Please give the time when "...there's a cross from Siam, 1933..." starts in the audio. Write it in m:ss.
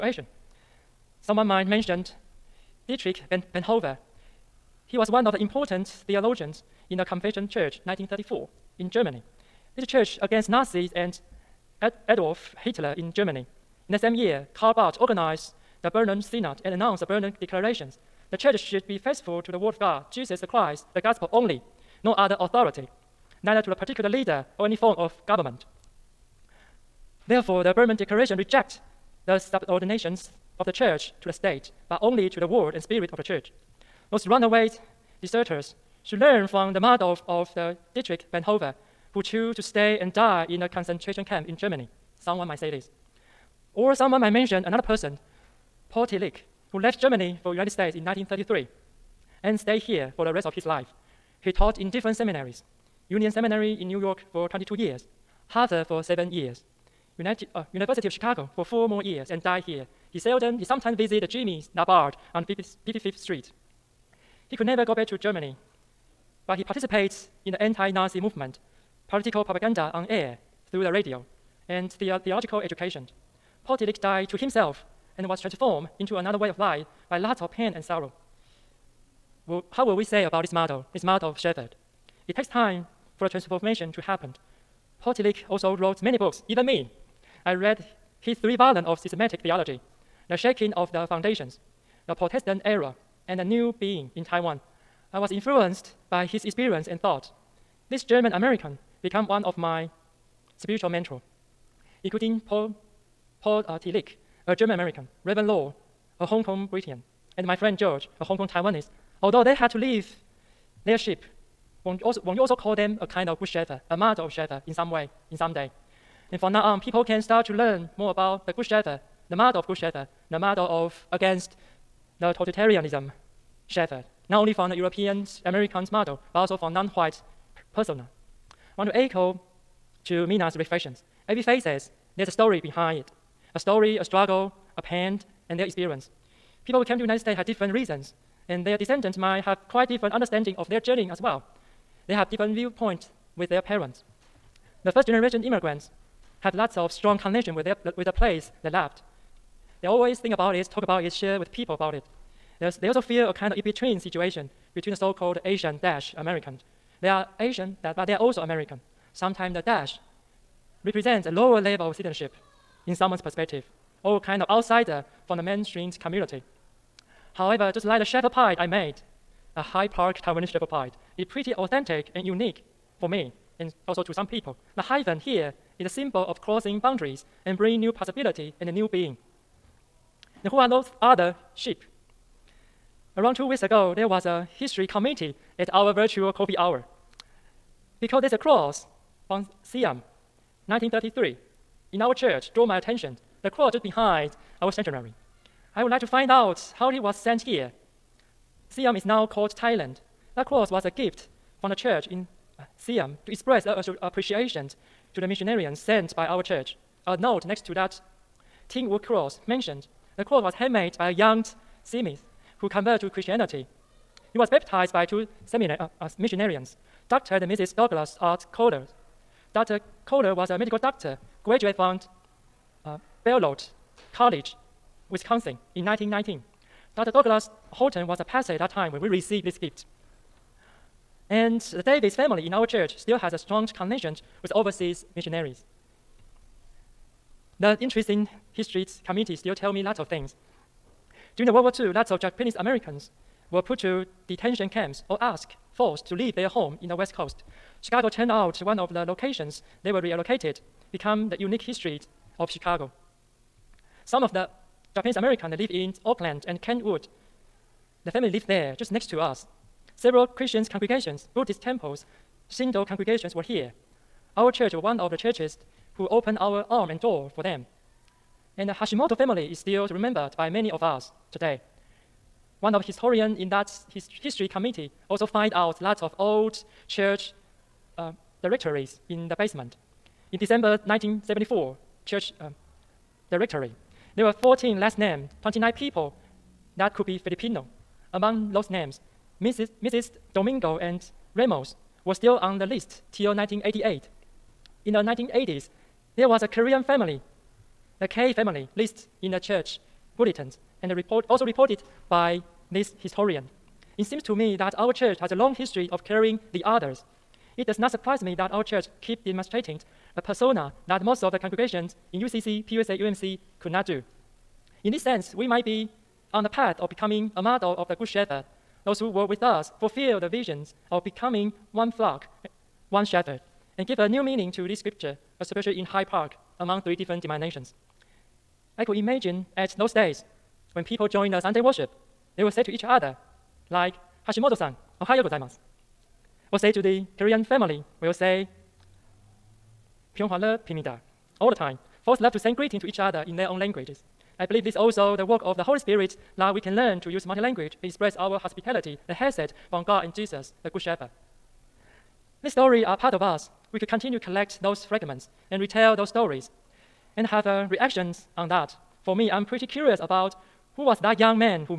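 3:08.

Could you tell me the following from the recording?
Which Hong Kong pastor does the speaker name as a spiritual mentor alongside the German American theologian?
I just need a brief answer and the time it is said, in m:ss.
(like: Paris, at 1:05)
Reverend Lo, at 1:45.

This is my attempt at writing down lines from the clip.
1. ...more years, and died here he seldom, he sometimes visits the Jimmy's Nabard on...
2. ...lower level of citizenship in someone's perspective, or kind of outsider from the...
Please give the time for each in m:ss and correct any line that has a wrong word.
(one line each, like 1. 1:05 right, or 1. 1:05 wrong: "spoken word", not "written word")
1. 0:58 right
2. 2:41 right.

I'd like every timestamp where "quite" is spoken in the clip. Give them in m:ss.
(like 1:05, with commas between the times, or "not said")
2:19.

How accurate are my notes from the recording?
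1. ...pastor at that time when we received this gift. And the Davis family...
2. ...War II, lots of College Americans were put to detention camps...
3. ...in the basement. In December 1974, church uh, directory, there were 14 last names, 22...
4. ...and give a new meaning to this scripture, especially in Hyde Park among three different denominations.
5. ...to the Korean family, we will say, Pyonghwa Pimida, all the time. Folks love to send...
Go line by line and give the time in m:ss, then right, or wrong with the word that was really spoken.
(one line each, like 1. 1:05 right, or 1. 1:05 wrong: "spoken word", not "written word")
1. 3:48 right
2. 4:01 wrong: "Japanese", not "College"
3. 4:39 wrong: "29", not "22"
4. 5:23 right
5. 5:36 right.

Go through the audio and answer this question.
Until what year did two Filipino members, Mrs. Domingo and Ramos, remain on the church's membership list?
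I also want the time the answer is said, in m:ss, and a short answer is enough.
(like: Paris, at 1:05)
1988, at 4:53.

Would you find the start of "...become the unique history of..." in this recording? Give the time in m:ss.
4:10.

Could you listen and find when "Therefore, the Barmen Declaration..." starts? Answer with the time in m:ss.
0:27.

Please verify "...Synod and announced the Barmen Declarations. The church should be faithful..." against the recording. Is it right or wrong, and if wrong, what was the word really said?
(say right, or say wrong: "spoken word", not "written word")
right.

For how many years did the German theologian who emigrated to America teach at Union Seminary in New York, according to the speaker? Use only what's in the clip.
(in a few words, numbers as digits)
22.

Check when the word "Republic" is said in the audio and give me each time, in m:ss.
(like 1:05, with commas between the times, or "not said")
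not said.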